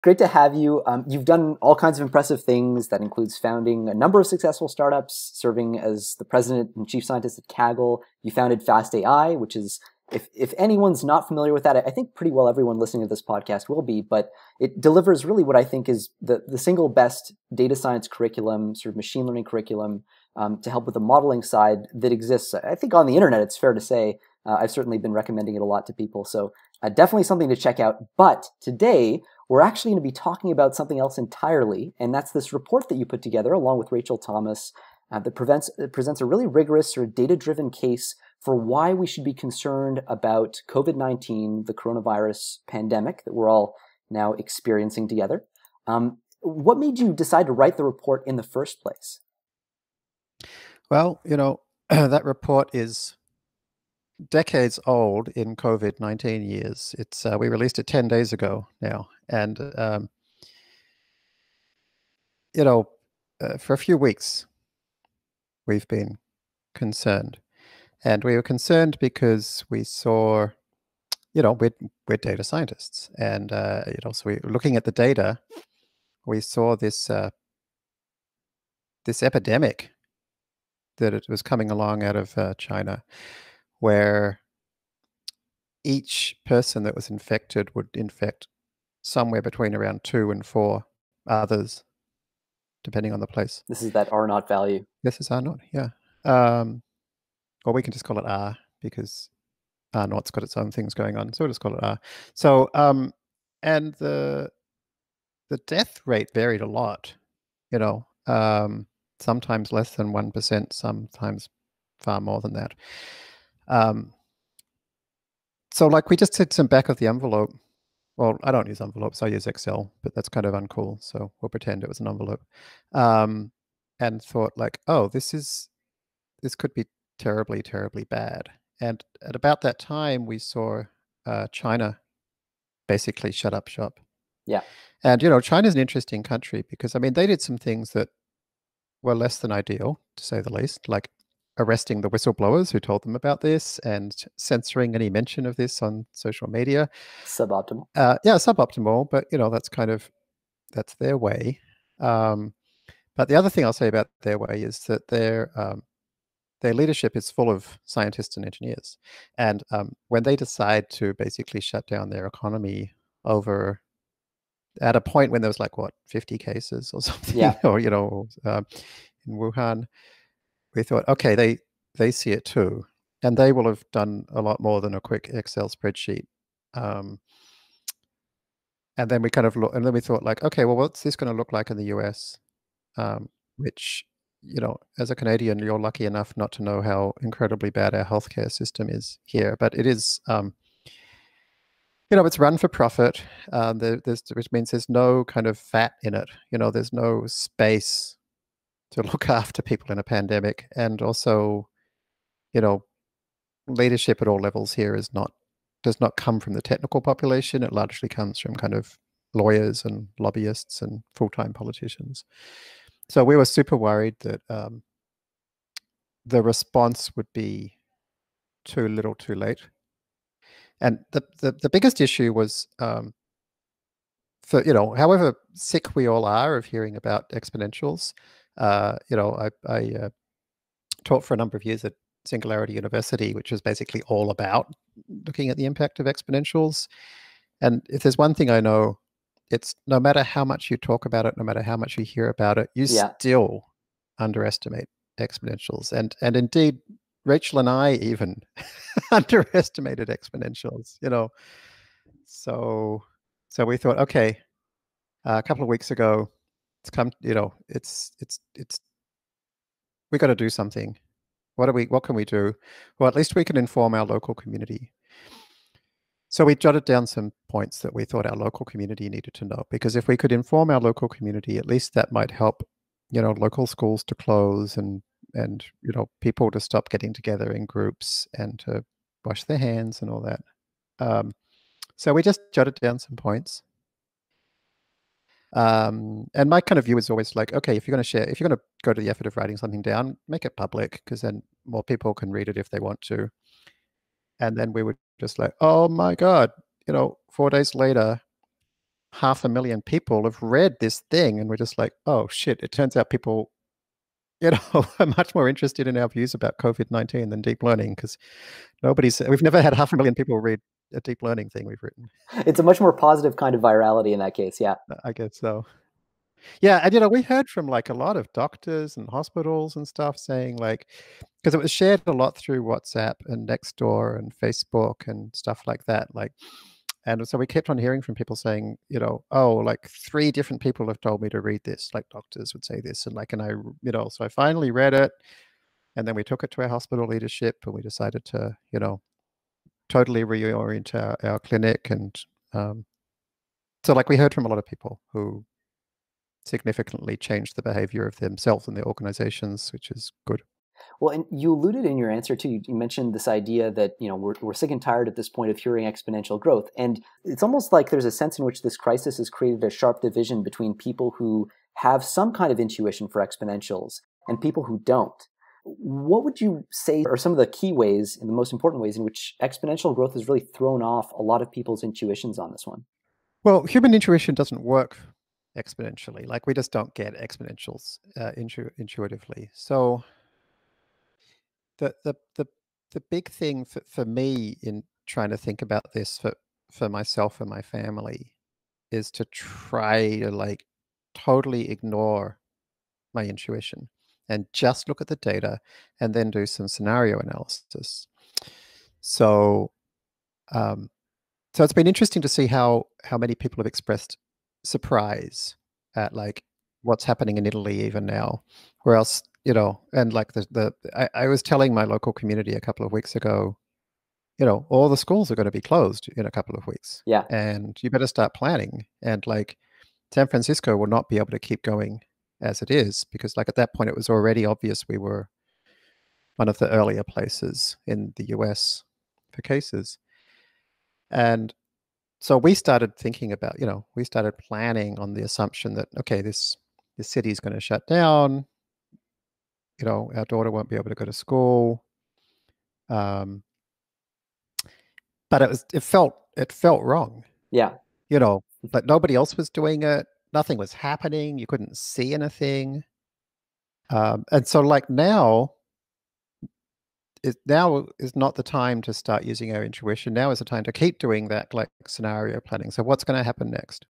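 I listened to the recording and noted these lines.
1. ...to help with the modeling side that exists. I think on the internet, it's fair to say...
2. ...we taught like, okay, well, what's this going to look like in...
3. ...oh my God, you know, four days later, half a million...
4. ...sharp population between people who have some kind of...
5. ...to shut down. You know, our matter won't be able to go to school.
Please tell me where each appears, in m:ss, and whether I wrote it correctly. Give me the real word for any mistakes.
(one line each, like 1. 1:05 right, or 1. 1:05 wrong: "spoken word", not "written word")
1. 0:20 right
2. 2:59 wrong: "thought", not "taught"
3. 4:55 right
4. 5:59 wrong: "division", not "population"
5. 7:17 wrong: "daughter", not "matter".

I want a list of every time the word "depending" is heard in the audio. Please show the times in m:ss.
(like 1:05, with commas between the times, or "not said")
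1:32.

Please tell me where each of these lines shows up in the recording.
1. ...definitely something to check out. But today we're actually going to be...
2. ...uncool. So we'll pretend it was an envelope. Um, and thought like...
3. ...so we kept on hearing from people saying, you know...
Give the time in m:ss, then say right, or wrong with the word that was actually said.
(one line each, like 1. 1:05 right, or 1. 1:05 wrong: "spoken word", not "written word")
1. 0:26 right
2. 2:00 right
3. 5:27 right.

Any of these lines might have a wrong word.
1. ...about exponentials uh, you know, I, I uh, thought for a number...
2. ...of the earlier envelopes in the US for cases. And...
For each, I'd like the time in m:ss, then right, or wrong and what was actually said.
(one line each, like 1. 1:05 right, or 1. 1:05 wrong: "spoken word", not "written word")
1. 3:46 wrong: "taught", not "thought"
2. 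7:06 wrong: "places", not "envelopes".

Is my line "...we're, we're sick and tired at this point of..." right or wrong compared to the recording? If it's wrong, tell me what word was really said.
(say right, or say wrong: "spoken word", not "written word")
right.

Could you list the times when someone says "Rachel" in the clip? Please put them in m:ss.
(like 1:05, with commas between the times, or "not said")
0:33, 4:07.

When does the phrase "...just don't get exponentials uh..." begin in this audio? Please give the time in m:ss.
6:16.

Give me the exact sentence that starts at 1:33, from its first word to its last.
This is that R naught value.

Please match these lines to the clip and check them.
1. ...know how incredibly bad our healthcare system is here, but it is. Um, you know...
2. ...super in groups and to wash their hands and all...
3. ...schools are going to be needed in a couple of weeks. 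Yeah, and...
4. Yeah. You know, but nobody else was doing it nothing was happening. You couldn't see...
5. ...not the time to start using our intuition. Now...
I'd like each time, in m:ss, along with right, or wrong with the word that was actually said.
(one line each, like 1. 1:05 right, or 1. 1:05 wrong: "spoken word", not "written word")
1. 3:06 right
2. 4:37 wrong: "together", not "super"
3. 6:54 wrong: "closed", not "needed"
4. 7:27 right
5. 7:38 right.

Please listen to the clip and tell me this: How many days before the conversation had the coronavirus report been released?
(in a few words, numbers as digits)
10.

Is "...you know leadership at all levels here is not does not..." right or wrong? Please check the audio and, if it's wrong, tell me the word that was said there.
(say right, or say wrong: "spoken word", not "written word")
right.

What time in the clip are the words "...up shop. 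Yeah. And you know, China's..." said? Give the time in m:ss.
2:13.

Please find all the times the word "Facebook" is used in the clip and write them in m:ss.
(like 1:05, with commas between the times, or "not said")
5:24.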